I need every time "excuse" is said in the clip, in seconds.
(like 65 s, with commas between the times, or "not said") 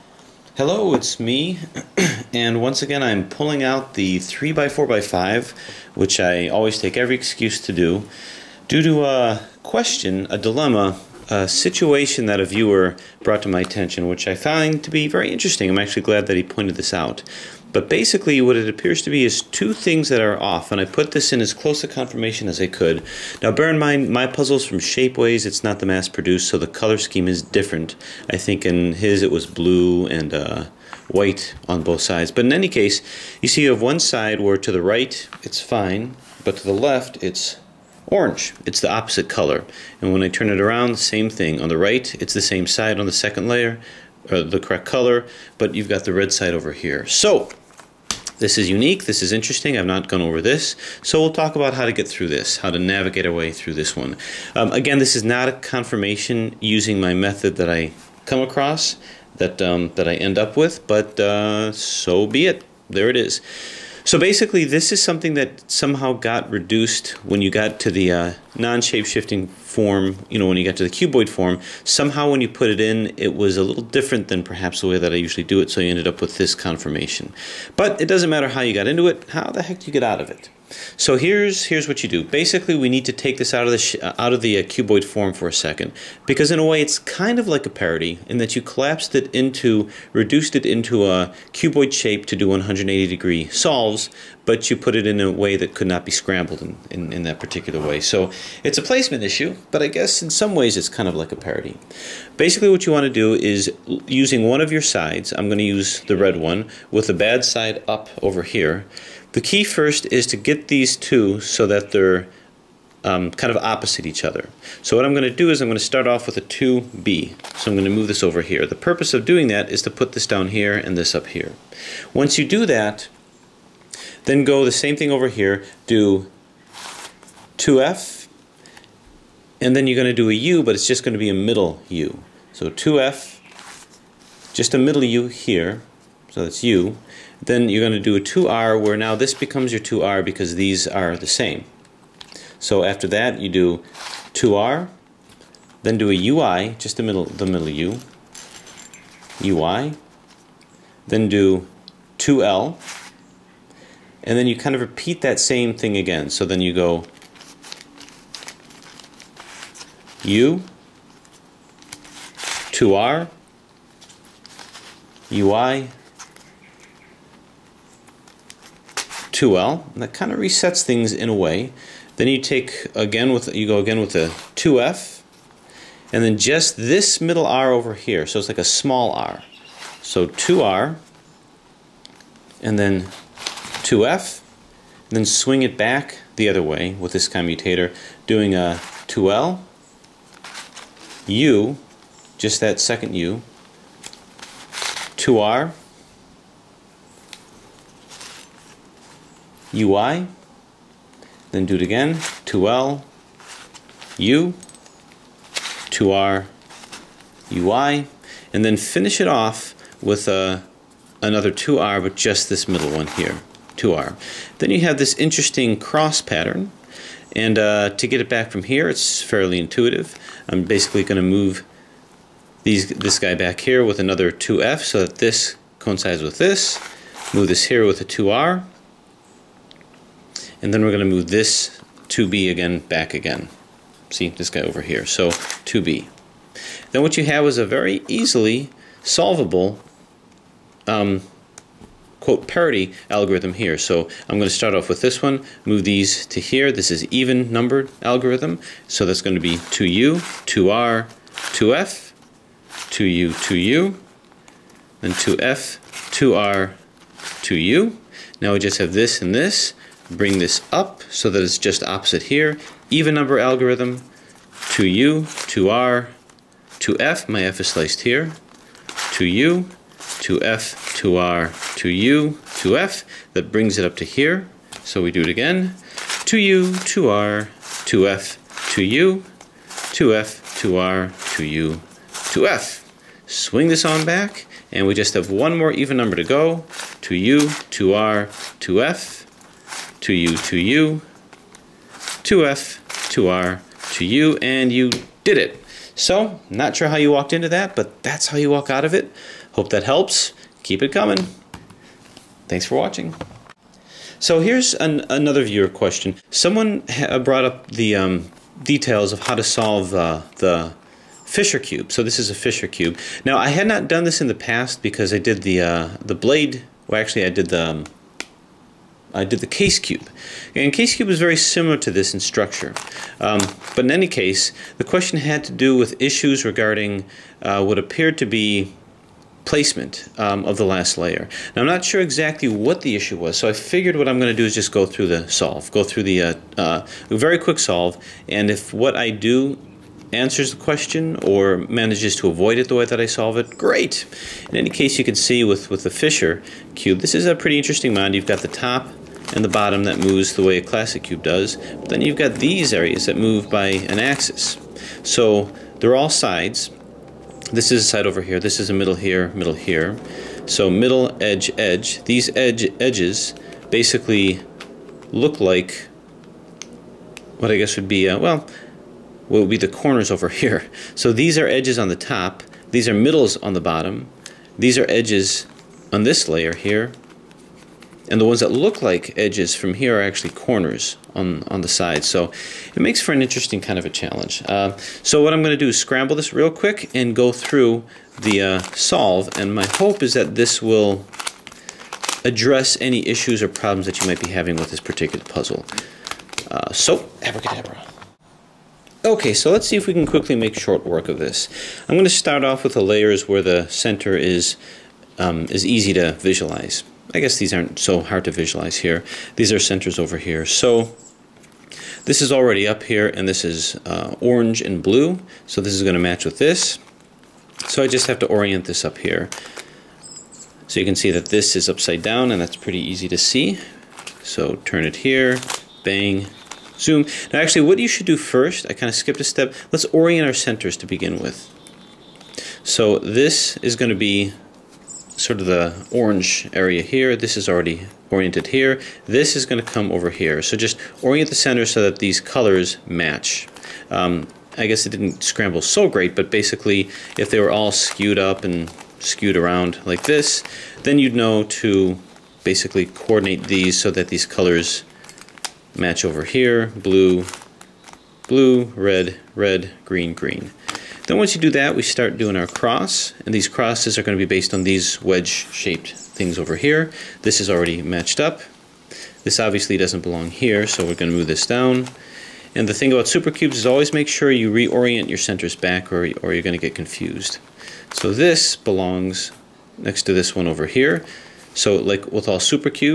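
7 s.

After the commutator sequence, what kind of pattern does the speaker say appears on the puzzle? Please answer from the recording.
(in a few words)
cross pattern.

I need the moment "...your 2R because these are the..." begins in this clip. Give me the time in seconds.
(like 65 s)
139 s.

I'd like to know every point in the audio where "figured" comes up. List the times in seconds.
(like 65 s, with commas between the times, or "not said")
333 s.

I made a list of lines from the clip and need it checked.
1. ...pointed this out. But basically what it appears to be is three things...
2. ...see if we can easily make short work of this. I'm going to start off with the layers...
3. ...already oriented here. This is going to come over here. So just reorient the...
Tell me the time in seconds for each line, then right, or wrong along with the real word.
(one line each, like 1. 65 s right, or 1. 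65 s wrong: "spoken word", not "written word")
1. 16 s wrong: "two", not "three"
2. 399 s wrong: "quickly", not "easily"
3. 437 s wrong: "orient", not "reorient".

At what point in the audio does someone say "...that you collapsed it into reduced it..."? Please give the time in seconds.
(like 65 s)
88 s.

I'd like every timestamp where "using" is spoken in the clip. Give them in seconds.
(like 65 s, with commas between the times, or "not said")
56 s, 104 s.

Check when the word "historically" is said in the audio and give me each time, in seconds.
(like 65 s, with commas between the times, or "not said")
not said.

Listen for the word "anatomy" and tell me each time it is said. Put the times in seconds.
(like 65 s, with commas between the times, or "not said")
not said.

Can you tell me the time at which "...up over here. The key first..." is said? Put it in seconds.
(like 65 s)
107 s.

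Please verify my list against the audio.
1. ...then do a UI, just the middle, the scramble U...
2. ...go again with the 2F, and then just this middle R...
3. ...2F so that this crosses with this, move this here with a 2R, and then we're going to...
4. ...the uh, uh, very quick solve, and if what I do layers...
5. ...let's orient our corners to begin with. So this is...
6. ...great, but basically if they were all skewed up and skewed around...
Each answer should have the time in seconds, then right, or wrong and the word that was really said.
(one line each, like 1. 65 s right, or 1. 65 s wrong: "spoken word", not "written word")
1. 145 s wrong: "middle", not "scramble"
2. 173 s right
3. 224 s wrong: "coincides", not "crosses"
4. 336 s wrong: "answers", not "layers"
5. 429 s wrong: "centers", not "corners"
6. 445 s right.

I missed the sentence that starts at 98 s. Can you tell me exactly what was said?
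So it's a placement issue, but I guess in some ways it's kind of like a parity.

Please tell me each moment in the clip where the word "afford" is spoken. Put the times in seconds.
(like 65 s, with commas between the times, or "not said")
not said.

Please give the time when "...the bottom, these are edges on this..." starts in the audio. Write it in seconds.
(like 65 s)
373 s.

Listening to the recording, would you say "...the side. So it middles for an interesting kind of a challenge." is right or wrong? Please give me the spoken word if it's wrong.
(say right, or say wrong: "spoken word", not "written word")
wrong: "makes", not "middles".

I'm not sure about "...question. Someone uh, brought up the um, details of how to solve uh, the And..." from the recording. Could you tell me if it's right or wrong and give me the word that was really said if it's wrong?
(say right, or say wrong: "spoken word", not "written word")
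wrong: "Fisher", not "And".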